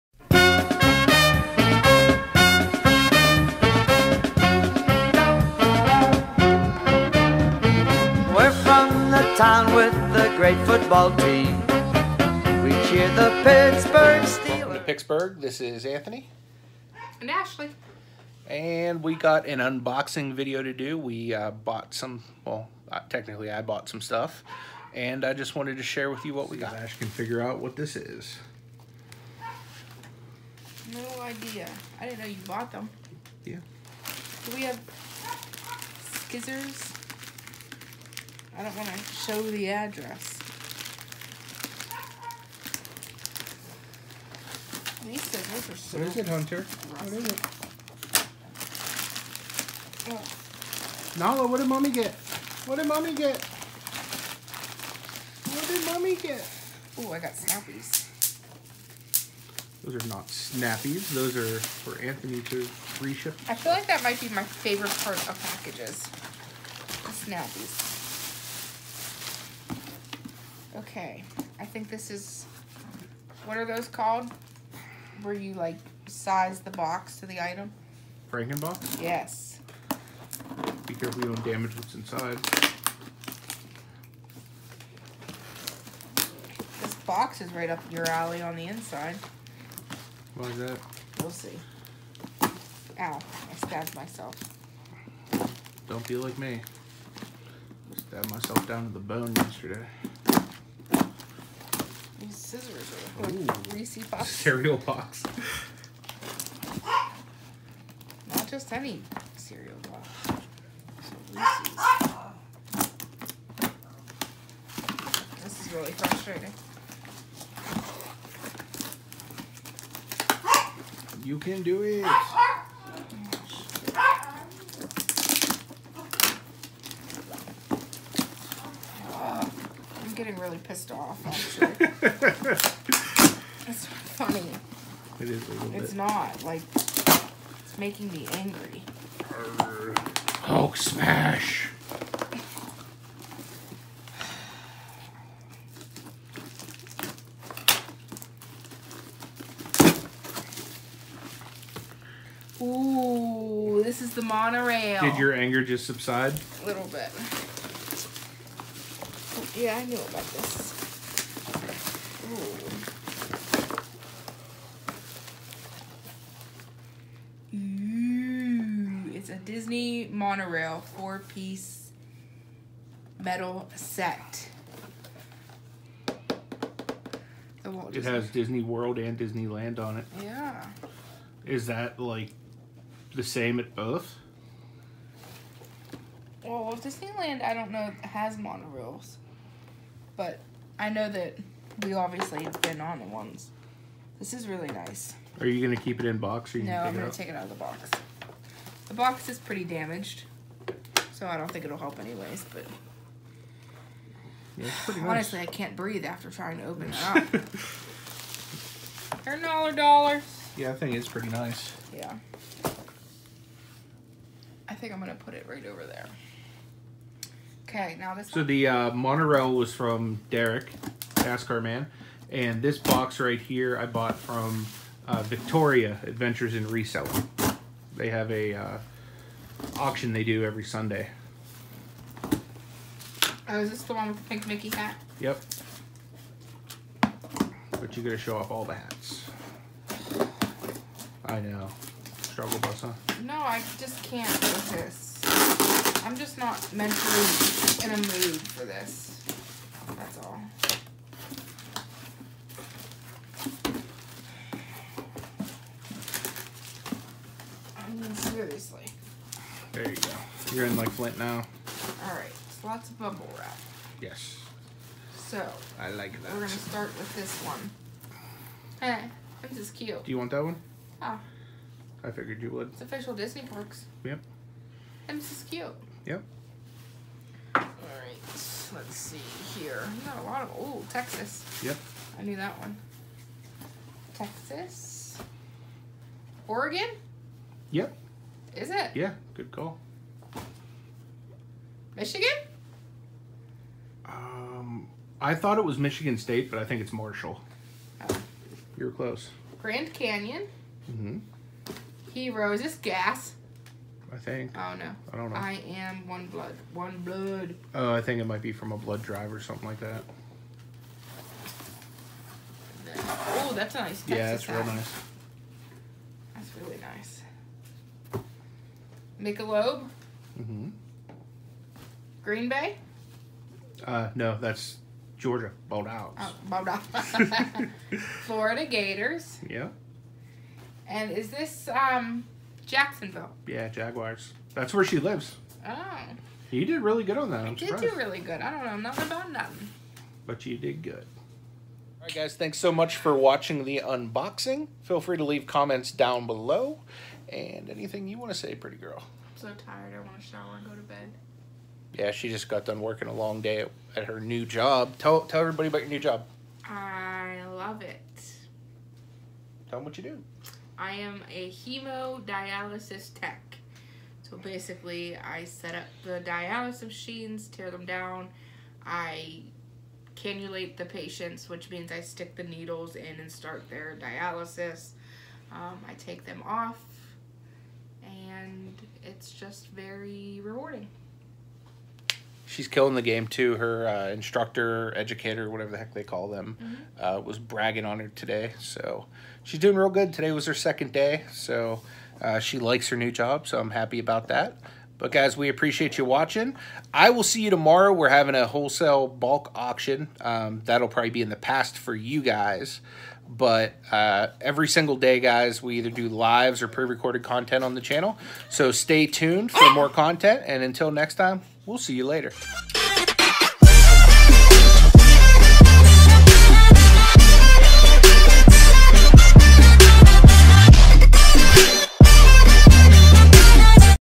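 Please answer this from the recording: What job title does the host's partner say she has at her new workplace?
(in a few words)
Hemodialysis tech.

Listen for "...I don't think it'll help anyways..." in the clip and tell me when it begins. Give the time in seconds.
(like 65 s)
201 s.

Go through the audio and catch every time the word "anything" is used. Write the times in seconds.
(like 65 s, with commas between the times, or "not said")
347 s.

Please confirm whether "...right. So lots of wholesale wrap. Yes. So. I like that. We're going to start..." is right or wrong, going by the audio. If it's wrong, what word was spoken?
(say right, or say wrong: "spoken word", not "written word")
wrong: "bubble", not "wholesale".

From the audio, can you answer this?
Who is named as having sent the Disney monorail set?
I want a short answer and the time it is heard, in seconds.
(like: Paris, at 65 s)
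Derek, at 220 s.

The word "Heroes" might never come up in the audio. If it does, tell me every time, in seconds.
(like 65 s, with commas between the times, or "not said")
302 s.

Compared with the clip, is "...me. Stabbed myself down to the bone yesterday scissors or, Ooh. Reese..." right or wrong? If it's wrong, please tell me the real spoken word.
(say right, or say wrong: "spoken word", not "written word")
right.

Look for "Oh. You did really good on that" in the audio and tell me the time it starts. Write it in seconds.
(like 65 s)
335 s.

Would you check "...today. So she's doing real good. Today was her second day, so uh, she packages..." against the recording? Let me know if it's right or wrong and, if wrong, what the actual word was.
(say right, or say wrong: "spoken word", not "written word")
wrong: "likes", not "packages".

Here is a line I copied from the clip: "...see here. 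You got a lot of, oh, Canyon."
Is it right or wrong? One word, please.
wrong.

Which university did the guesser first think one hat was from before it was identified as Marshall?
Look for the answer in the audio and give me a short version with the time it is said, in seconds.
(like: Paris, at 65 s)
Michigan State, at 295 s.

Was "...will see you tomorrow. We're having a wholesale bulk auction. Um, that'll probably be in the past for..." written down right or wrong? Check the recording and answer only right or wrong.
right.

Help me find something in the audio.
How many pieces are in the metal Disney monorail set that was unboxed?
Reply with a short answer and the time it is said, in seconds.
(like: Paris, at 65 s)
4, at 170 s.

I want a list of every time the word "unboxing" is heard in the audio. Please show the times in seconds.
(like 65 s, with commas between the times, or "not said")
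19 s, 343 s.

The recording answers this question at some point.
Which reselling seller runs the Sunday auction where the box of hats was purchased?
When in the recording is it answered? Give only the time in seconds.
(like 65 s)
225 s.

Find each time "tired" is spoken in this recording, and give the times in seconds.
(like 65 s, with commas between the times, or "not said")
349 s.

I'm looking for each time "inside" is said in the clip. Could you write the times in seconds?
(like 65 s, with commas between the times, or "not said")
81 s, 88 s.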